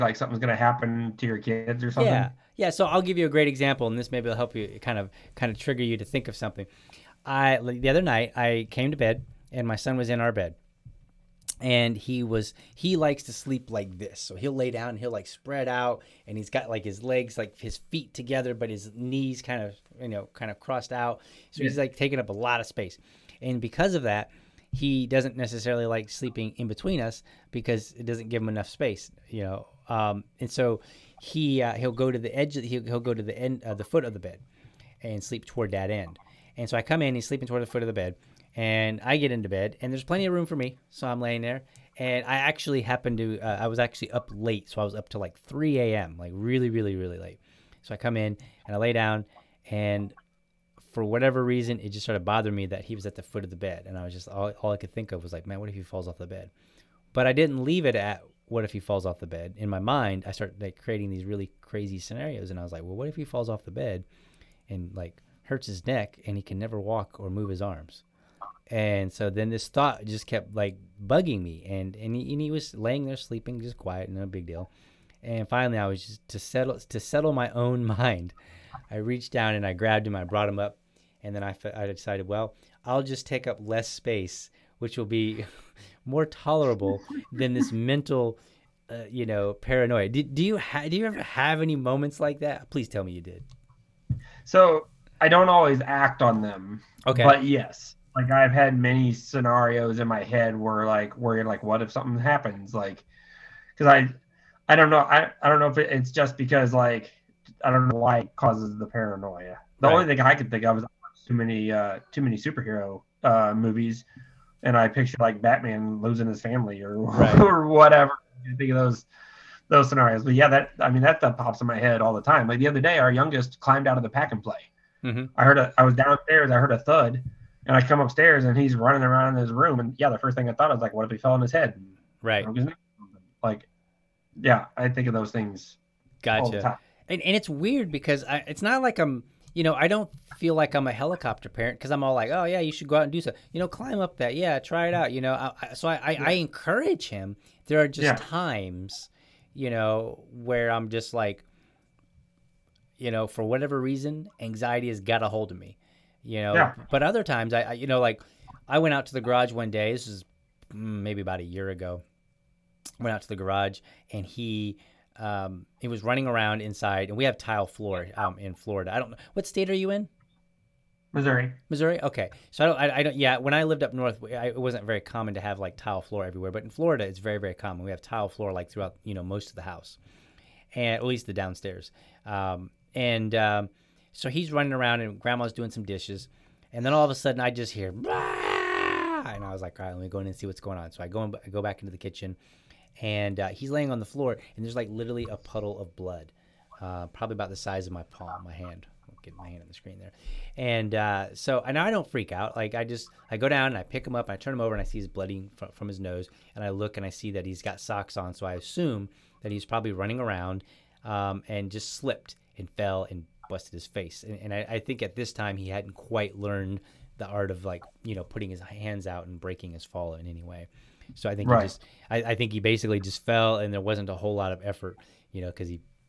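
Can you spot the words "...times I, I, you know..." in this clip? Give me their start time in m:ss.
2:37.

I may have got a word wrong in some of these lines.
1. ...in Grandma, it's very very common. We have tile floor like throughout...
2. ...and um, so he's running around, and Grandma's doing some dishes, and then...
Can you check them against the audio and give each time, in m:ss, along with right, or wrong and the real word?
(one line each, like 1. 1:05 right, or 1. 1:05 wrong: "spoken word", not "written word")
1. 2:56 wrong: "Florida", not "Grandma"
2. 3:02 right.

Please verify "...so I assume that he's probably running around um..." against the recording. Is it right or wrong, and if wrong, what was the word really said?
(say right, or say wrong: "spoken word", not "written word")
right.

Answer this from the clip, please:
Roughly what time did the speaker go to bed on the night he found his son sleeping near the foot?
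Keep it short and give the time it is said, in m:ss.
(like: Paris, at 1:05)
3 a.m., at 0:45.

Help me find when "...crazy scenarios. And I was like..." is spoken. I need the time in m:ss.
1:01.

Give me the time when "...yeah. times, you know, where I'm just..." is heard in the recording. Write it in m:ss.
2:28.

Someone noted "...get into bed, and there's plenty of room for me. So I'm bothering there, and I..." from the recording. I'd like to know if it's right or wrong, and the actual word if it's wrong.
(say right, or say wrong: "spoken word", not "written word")
wrong: "laying", not "bothering".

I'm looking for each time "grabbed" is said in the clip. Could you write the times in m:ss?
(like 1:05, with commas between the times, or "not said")
1:19.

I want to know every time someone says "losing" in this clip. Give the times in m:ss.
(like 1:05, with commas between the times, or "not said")
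1:56.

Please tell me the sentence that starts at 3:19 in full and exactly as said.
Get my hand on the screen there, and uh, so and I don't freak out.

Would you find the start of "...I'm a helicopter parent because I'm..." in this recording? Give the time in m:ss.
2:20.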